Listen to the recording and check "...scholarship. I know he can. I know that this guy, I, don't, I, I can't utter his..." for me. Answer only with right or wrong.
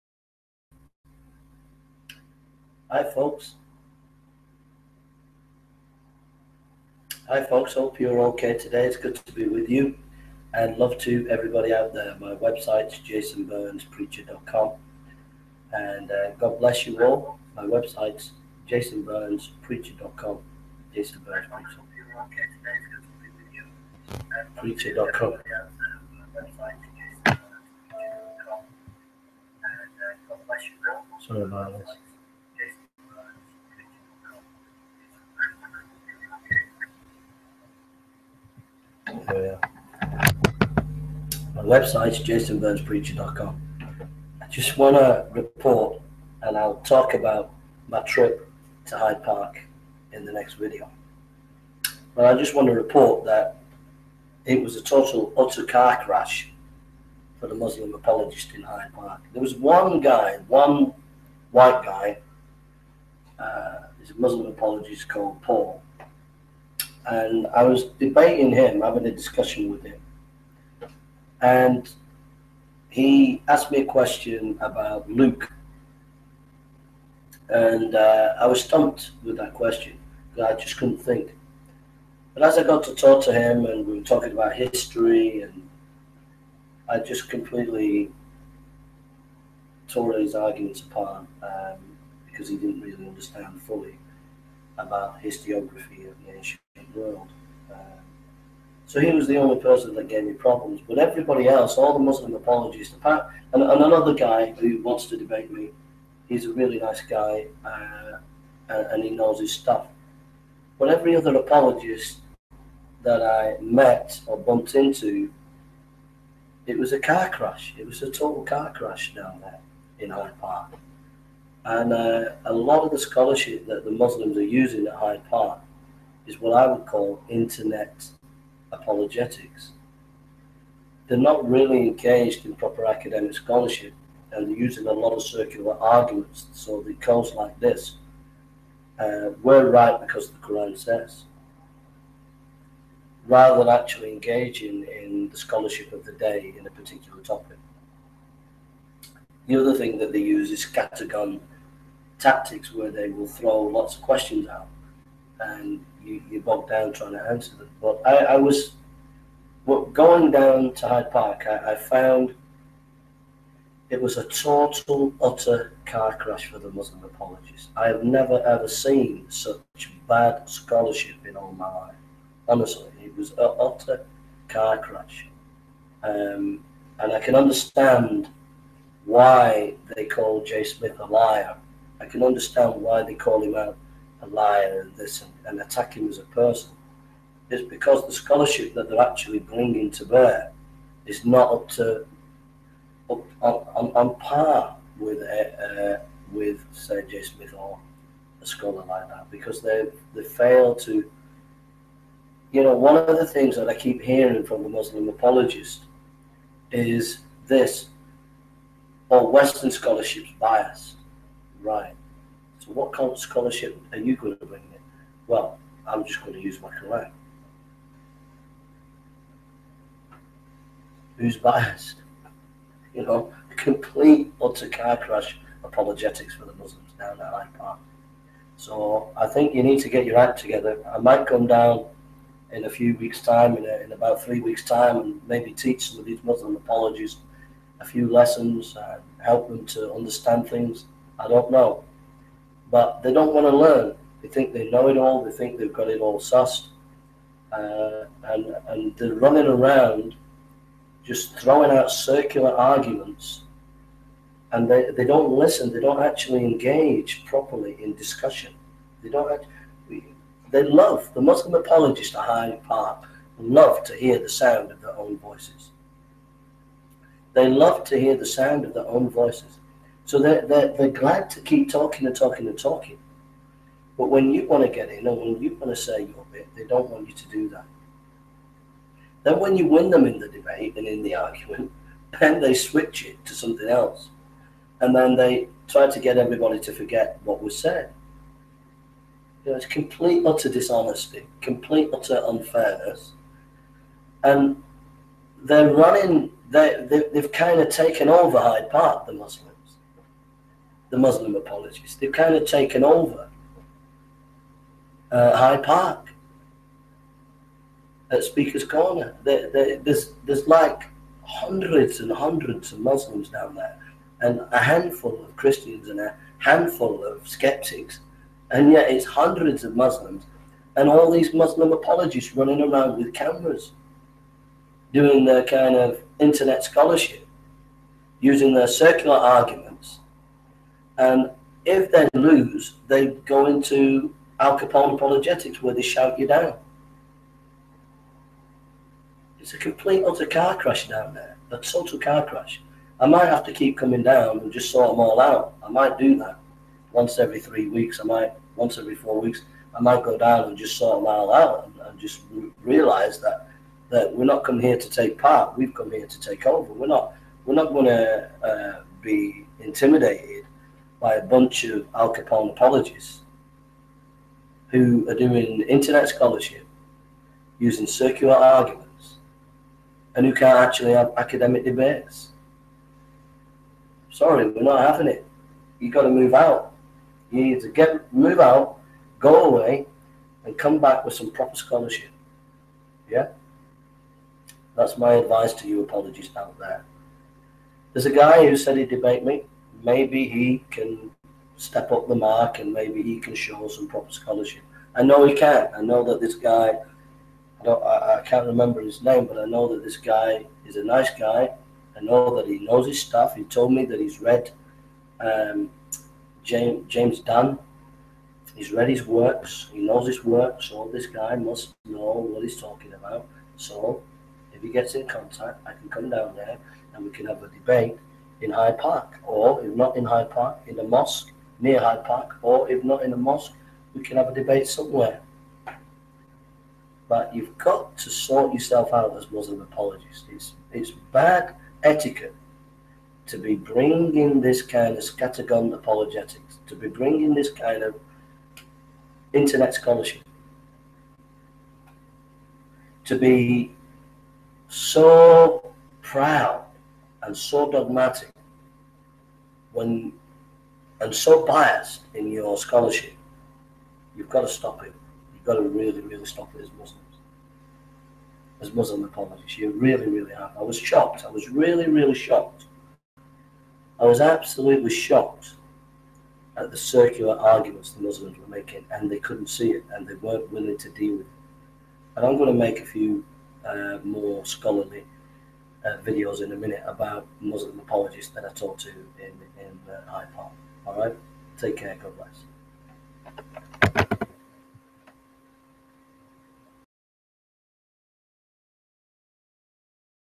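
wrong.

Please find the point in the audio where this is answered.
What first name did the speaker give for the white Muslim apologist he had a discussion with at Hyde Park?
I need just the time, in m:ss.
1:05.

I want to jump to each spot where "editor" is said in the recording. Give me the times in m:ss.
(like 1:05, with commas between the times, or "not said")
not said.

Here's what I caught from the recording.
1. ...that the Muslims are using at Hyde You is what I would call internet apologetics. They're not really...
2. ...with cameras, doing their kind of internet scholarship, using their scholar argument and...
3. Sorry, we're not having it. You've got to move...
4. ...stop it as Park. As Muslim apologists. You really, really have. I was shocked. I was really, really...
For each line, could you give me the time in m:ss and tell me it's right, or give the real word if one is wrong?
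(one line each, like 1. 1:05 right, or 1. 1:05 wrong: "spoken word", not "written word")
1. 2:03 wrong: "Park", not "You"
2. 5:22 wrong: "circular", not "scholar"
3. 6:14 right
4. 7:36 wrong: "Muslims", not "Park".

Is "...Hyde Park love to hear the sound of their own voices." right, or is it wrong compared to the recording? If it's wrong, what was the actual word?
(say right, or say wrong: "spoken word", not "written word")
right.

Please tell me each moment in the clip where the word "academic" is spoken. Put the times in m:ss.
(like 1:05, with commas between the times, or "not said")
2:12, 6:11.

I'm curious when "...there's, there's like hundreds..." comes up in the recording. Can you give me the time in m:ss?
5:09.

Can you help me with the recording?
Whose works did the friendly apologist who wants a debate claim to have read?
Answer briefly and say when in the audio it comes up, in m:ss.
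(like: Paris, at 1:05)
James Dunn, at 6:46.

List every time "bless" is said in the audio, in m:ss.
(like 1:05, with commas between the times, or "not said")
0:16, 8:02.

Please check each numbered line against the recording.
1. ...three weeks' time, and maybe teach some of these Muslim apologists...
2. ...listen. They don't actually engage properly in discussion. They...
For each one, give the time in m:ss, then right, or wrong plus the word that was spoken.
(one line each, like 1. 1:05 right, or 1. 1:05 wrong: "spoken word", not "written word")
1. 3:54 right
2. 4:15 right.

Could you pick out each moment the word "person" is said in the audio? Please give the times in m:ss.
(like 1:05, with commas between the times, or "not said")
1:39, 3:06.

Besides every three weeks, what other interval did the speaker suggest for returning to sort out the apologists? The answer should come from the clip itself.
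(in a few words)
Every four weeks.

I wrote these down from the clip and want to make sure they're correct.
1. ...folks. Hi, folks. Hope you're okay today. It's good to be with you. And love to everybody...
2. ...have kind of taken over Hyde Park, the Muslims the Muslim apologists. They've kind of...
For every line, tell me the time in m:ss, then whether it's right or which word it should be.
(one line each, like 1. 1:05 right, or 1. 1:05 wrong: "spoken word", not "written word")
1. 0:03 right
2. 4:57 right.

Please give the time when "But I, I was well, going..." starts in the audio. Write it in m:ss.
2:37.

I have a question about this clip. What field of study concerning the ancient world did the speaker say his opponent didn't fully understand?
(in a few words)
Historiography.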